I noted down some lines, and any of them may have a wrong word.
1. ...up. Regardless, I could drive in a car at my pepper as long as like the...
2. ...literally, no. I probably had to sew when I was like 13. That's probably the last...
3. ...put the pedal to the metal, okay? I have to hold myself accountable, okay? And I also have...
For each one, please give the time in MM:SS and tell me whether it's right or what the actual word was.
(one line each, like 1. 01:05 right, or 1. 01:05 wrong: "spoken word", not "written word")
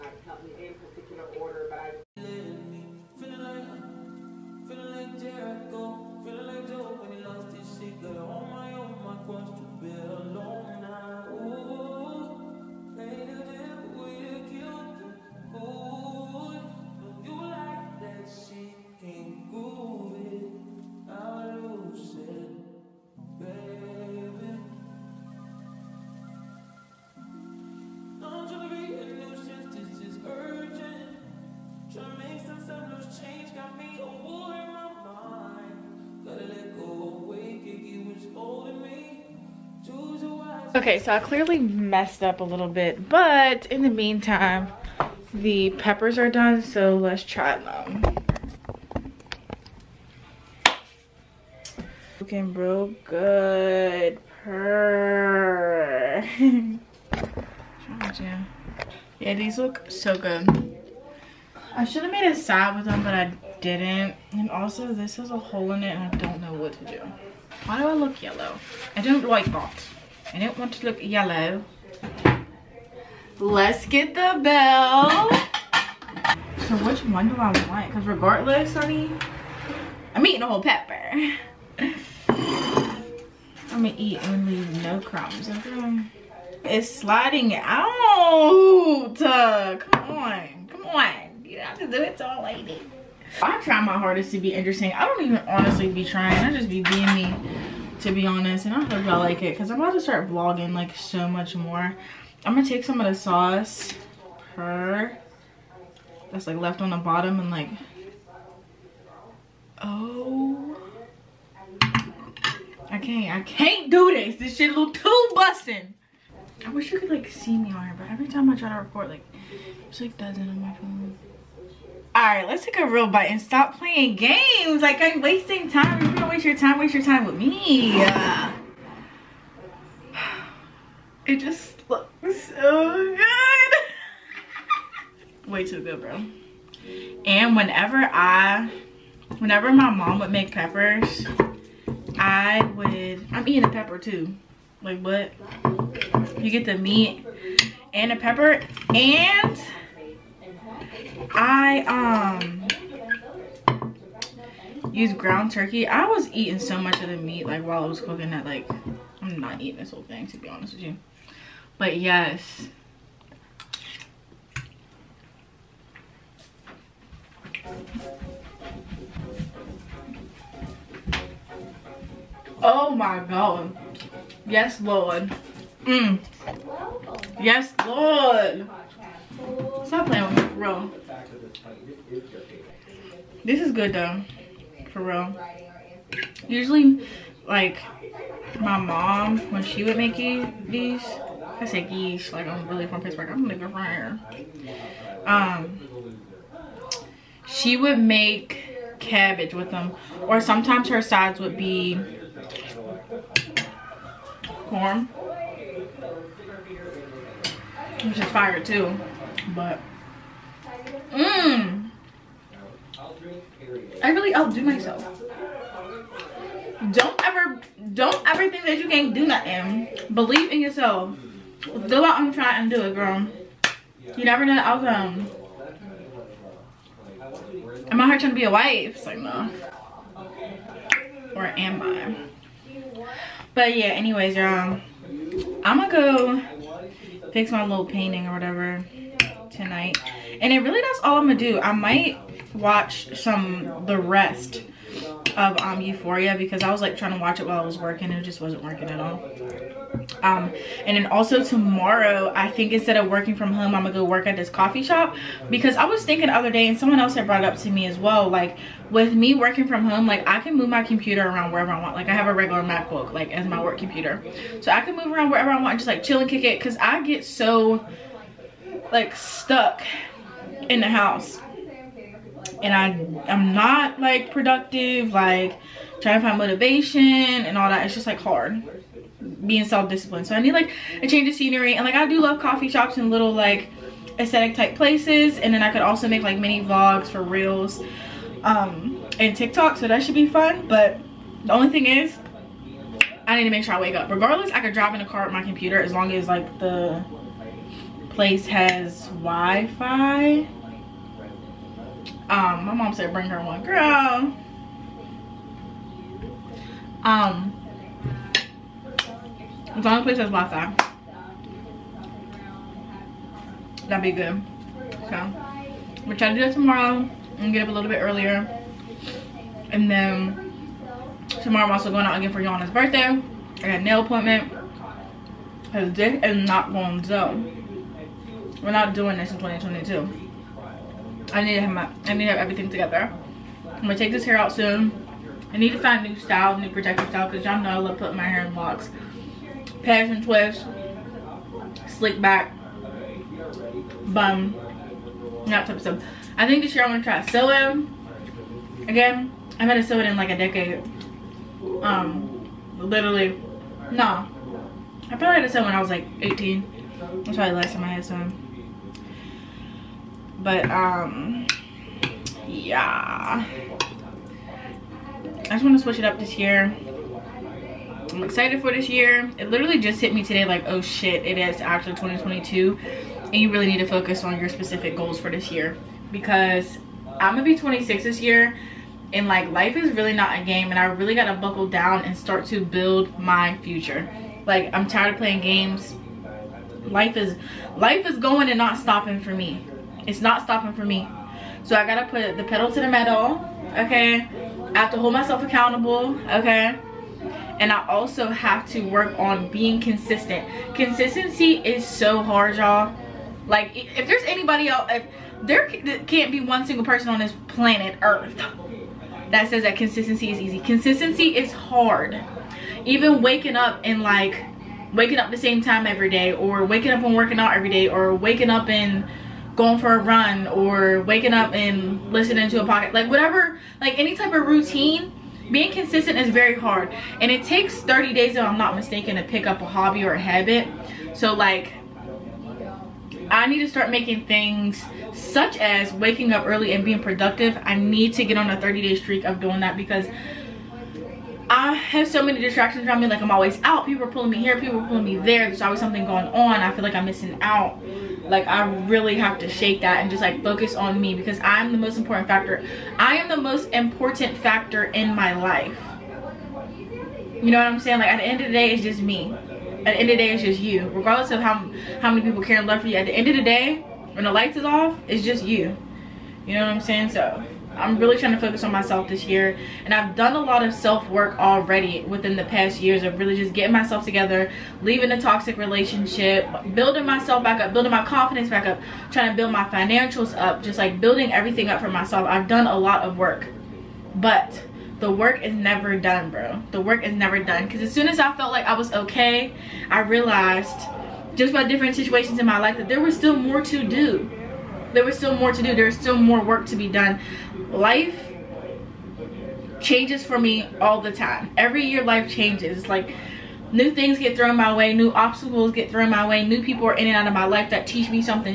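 1. 04:53 wrong: "computer", not "pepper"
2. 05:52 wrong: "18", not "13"
3. 06:32 right.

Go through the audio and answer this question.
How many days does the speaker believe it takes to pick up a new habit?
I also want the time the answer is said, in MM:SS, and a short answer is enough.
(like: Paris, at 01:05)
30, at 07:07.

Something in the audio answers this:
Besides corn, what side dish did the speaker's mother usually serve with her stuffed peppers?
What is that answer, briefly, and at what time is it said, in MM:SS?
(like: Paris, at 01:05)
cabbage, at 03:18.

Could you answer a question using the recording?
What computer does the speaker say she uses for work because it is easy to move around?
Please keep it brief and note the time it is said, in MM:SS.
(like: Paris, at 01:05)
MacBook, at 04:22.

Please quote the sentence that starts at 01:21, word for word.
I'm gonna eat and leave no crumbs, okay?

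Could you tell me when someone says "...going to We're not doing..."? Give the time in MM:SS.
05:26.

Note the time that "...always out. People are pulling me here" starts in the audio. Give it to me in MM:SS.
07:23.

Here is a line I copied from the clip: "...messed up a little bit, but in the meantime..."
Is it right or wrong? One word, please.
right.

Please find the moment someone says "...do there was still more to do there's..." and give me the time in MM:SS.
08:13.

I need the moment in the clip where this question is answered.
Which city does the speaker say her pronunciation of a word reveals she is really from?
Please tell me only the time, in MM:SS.
03:13.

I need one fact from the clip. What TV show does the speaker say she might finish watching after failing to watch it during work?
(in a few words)
Euphoria.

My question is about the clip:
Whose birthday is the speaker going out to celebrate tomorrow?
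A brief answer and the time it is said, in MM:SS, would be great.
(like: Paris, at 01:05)
Yana, at 05:22.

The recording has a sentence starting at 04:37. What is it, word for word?
It's just like hard being self-disciplined.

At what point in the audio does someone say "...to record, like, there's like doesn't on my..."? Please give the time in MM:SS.
01:58.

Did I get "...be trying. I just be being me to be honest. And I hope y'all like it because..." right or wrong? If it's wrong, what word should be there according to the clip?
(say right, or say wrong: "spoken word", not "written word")
right.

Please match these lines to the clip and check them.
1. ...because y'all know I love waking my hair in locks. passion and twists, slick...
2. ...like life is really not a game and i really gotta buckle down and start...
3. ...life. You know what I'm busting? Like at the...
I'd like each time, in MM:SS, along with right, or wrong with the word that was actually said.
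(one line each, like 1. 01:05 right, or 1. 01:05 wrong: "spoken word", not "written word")
1. 05:37 wrong: "putting", not "waking"
2. 06:19 right
3. 07:35 wrong: "saying", not "busting".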